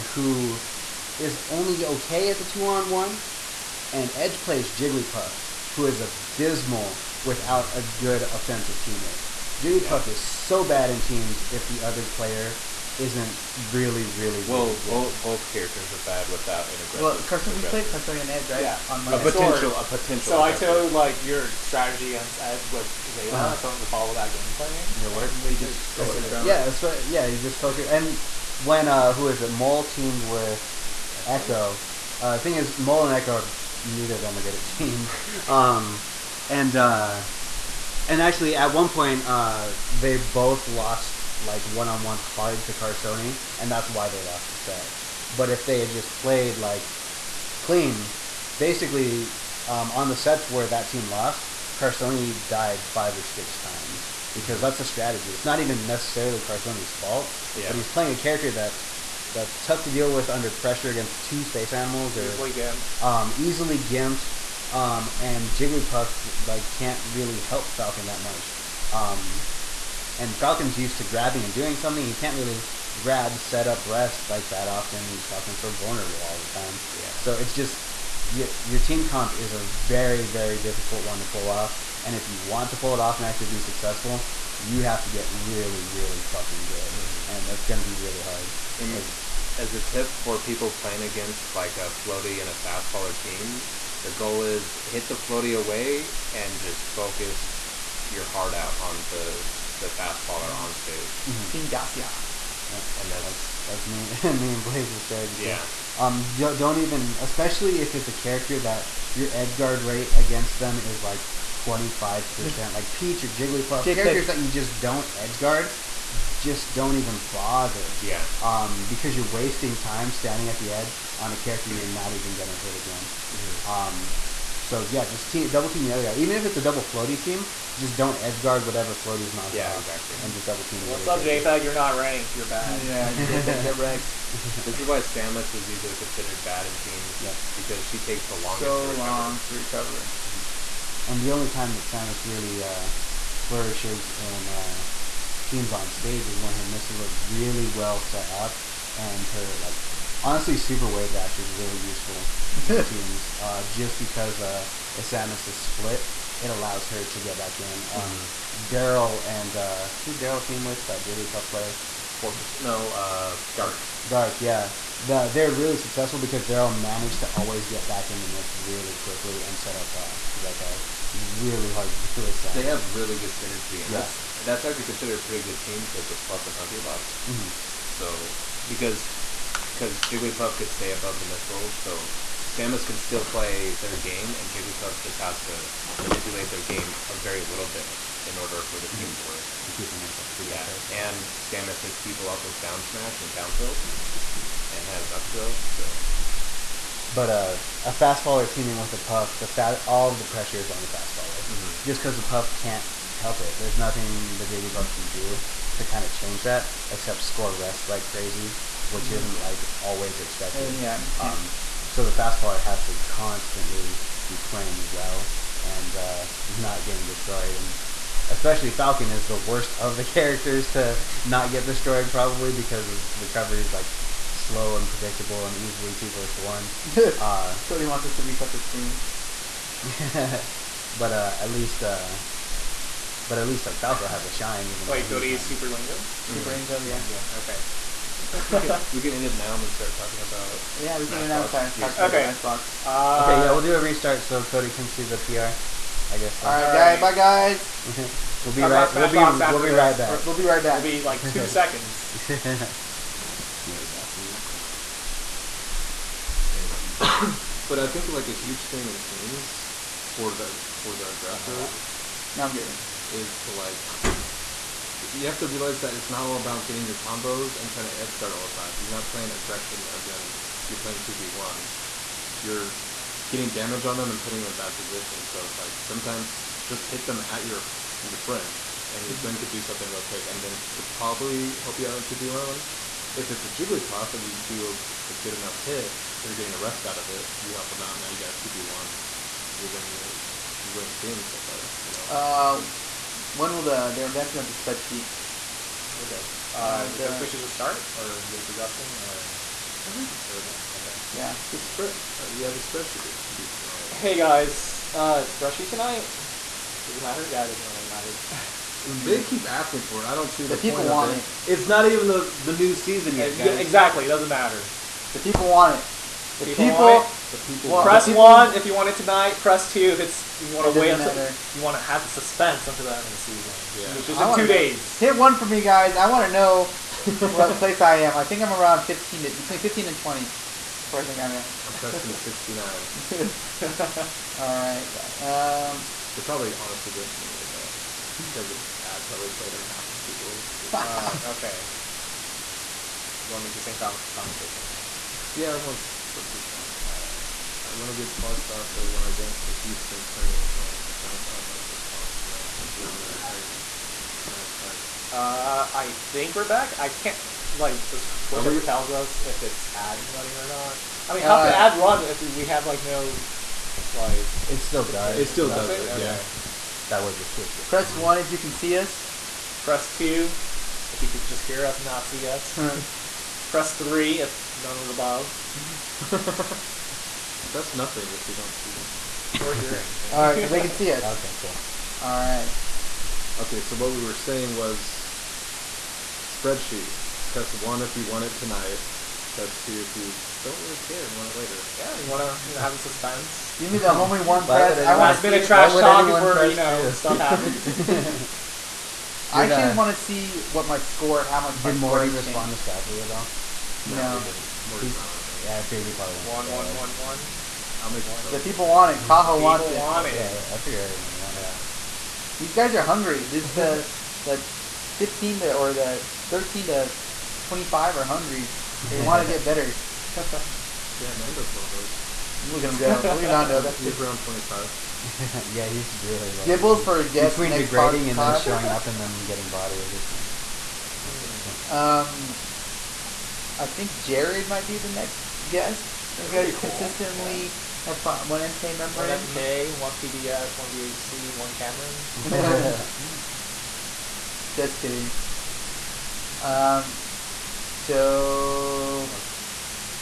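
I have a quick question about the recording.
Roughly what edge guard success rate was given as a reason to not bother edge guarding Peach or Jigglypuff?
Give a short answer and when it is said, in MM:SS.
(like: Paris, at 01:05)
25 percent, at 01:51.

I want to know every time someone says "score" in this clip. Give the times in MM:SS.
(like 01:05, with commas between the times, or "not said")
03:27, 06:40.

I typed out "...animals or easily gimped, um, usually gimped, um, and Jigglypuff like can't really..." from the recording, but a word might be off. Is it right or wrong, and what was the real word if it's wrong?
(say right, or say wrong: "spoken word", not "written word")
wrong: "easily", not "usually".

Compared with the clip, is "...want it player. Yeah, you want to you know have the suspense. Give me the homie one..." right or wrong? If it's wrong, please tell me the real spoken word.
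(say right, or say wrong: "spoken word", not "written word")
wrong: "later", not "player".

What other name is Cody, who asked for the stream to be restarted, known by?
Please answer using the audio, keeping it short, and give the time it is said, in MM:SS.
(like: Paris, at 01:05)
Super Lingo, at 03:55.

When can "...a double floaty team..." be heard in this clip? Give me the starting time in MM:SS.
02:06.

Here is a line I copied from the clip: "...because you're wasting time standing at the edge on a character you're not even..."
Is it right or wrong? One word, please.
right.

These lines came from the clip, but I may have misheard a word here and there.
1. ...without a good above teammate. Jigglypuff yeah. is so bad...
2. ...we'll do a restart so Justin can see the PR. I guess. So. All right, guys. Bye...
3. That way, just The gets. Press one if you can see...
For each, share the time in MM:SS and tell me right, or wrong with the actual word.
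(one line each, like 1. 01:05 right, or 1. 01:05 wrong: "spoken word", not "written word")
1. 00:07 wrong: "offensive", not "above"
2. 04:03 wrong: "Cody", not "Justin"
3. 06:06 wrong: "Twitch", not "The".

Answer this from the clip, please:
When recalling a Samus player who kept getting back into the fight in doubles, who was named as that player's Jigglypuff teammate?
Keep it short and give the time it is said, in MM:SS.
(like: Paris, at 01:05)
Dark, at 02:42.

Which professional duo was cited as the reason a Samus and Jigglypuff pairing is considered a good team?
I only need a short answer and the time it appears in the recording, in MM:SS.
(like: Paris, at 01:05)
Plup and Hungrybox, at 02:56.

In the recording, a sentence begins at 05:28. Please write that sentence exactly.
I think I'm around 15 to, between 15 and 20.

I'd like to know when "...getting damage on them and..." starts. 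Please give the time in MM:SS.
04:33.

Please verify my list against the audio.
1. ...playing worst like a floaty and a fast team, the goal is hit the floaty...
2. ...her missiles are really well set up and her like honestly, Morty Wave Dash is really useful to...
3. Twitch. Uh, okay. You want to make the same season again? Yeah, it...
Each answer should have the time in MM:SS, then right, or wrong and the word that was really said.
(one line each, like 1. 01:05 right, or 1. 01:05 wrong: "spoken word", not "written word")
1. 01:30 wrong: "against", not "worst"
2. 02:26 wrong: "Super", not "Morty"
3. 05:40 wrong: "conversation", not "season".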